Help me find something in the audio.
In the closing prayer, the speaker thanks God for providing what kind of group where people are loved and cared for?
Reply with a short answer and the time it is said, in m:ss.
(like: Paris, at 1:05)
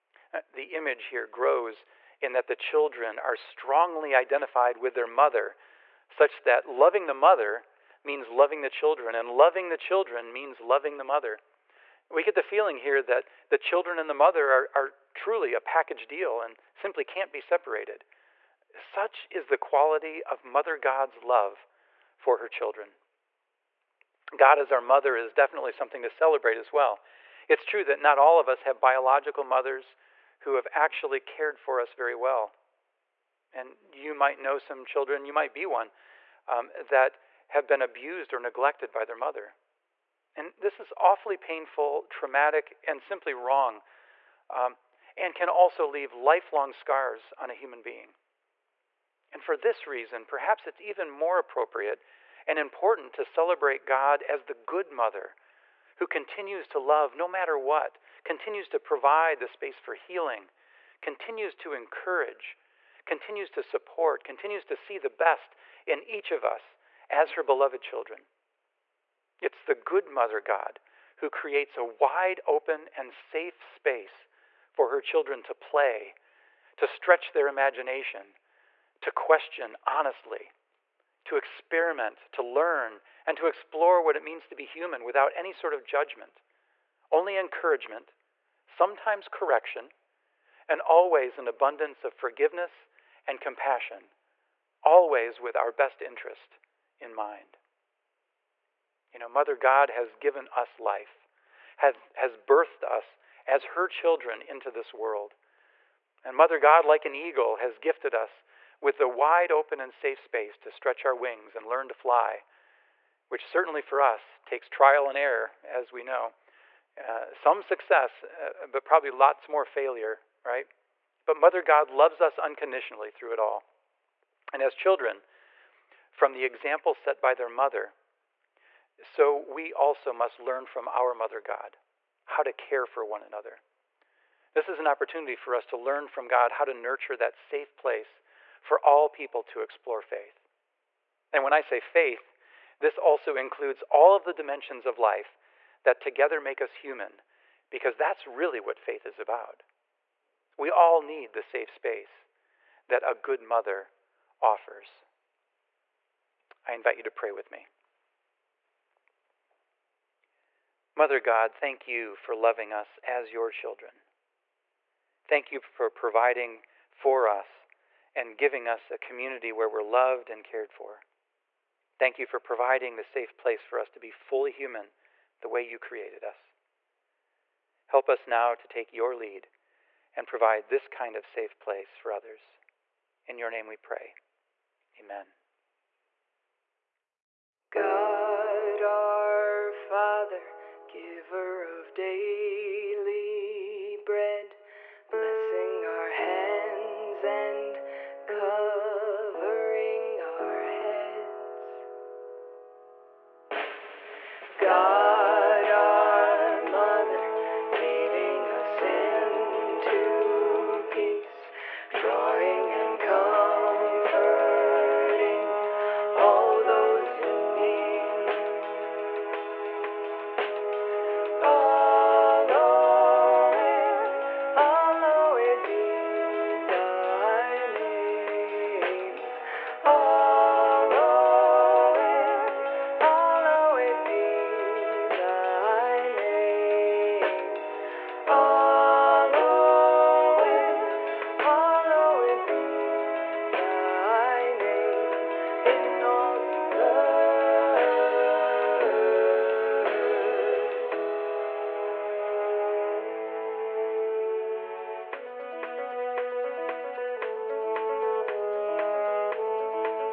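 A community, at 2:48.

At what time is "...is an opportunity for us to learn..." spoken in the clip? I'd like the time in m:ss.
2:14.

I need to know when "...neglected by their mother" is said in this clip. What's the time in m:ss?
0:38.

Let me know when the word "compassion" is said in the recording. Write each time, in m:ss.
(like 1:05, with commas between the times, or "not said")
1:33.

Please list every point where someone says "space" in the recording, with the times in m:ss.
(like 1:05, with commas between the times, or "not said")
0:59, 1:13, 1:50, 2:31.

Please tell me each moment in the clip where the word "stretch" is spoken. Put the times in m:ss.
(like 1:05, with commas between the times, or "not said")
1:16, 1:50.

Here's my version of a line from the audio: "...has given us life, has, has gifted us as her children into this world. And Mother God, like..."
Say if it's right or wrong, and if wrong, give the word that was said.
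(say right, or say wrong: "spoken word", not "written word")
wrong: "birthed", not "gifted".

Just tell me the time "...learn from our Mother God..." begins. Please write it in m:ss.
2:10.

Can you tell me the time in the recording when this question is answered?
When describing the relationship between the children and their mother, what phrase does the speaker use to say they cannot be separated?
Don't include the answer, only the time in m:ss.
0:15.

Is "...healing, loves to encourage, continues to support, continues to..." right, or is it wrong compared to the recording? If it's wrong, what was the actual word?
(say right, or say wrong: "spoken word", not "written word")
wrong: "continues", not "loves".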